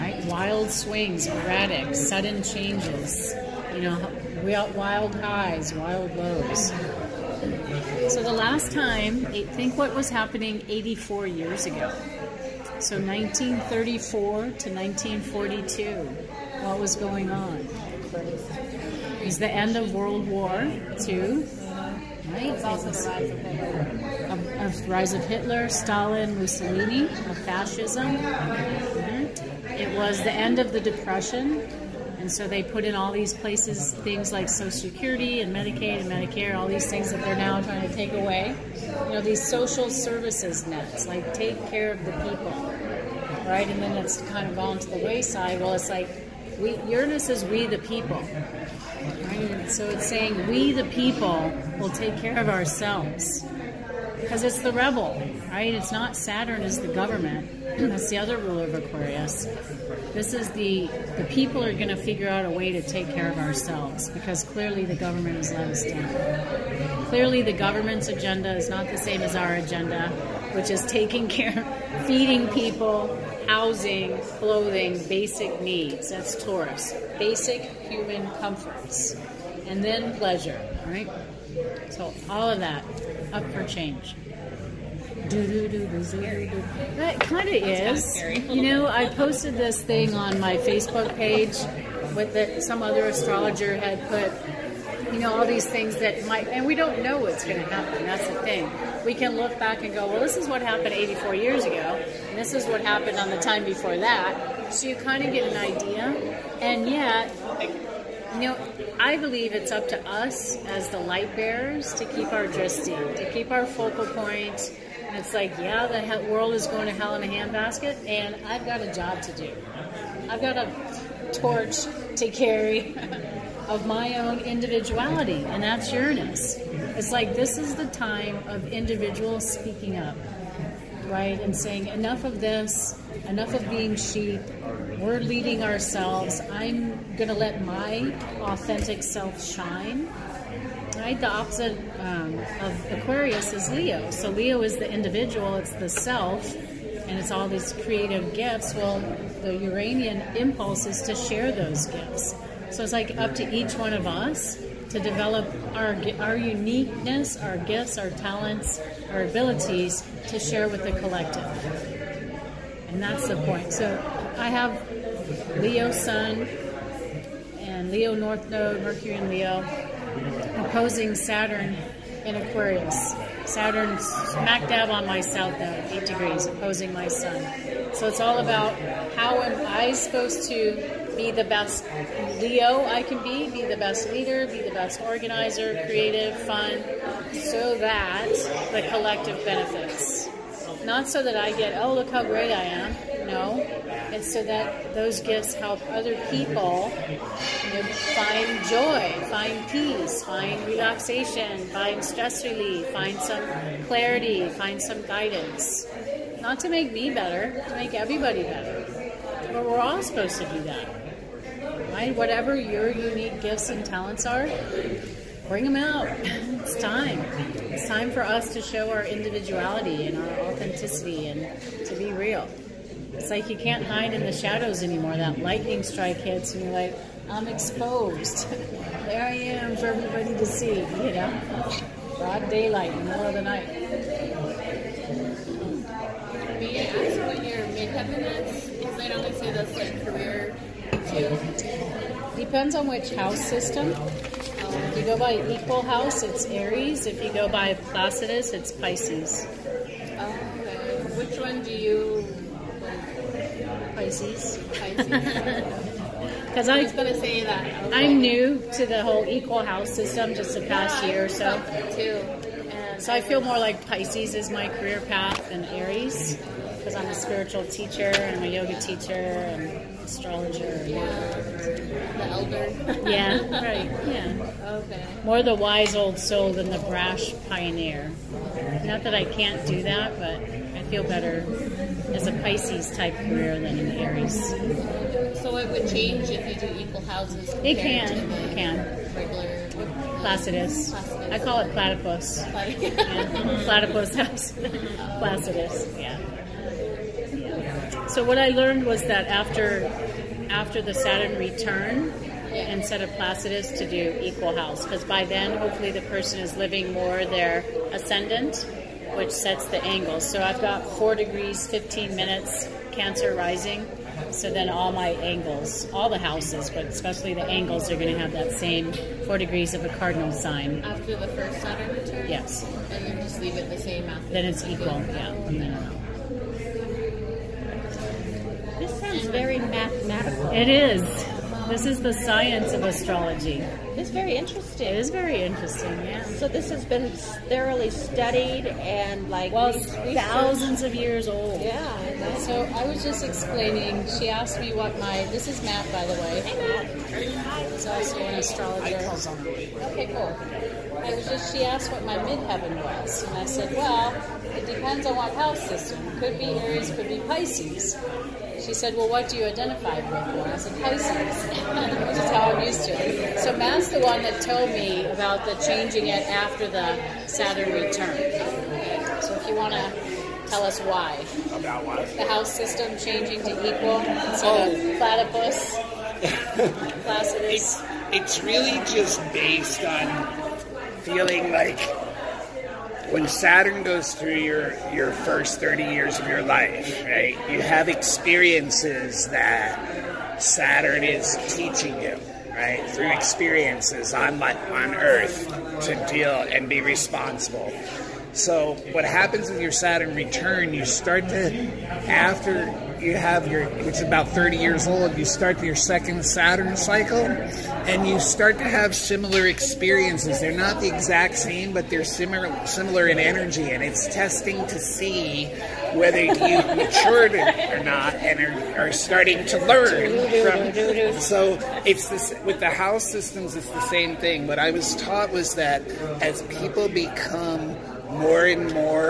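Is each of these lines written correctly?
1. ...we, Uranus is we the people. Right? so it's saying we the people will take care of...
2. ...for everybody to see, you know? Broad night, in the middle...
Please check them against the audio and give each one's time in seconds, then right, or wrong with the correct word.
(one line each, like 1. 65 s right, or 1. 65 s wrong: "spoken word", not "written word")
1. 46 s right
2. 229 s wrong: "daylight", not "night".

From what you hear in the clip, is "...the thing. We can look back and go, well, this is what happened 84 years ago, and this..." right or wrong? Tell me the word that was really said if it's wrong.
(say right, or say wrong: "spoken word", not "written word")
right.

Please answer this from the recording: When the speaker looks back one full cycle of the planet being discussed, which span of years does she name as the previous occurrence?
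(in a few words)
1934 to 1942.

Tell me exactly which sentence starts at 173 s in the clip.
Saturn smack dab on my south node, eight degrees, opposing my sun.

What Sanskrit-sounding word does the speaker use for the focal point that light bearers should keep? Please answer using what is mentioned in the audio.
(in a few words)
drishti.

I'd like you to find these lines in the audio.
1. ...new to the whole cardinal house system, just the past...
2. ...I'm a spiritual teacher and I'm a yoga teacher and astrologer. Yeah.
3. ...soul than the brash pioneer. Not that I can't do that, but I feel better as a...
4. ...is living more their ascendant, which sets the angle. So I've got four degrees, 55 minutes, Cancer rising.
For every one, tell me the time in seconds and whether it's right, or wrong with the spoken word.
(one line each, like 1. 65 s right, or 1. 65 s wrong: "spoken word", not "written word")
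1. 258 s wrong: "equal", not "cardinal"
2. 266 s right
3. 276 s right
4. 306 s wrong: "15", not "55".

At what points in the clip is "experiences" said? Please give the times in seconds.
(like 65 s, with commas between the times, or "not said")
387 s, 393 s, 409 s.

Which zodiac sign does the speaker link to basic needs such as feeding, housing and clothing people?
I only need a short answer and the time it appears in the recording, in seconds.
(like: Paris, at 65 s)
Taurus, at 76 s.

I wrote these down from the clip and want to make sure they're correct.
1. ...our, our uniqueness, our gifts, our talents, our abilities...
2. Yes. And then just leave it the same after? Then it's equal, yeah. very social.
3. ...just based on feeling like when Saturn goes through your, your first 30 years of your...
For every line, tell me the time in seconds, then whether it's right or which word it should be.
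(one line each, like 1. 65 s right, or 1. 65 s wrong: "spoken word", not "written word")
1. 155 s right
2. 322 s wrong: "mathematical", not "social"
3. 378 s right.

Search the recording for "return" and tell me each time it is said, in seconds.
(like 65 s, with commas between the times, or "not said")
301 s, 321 s, 367 s, 400 s.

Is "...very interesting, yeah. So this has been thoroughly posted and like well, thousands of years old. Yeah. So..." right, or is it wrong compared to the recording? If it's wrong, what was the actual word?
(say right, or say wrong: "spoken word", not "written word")
wrong: "studied", not "posted".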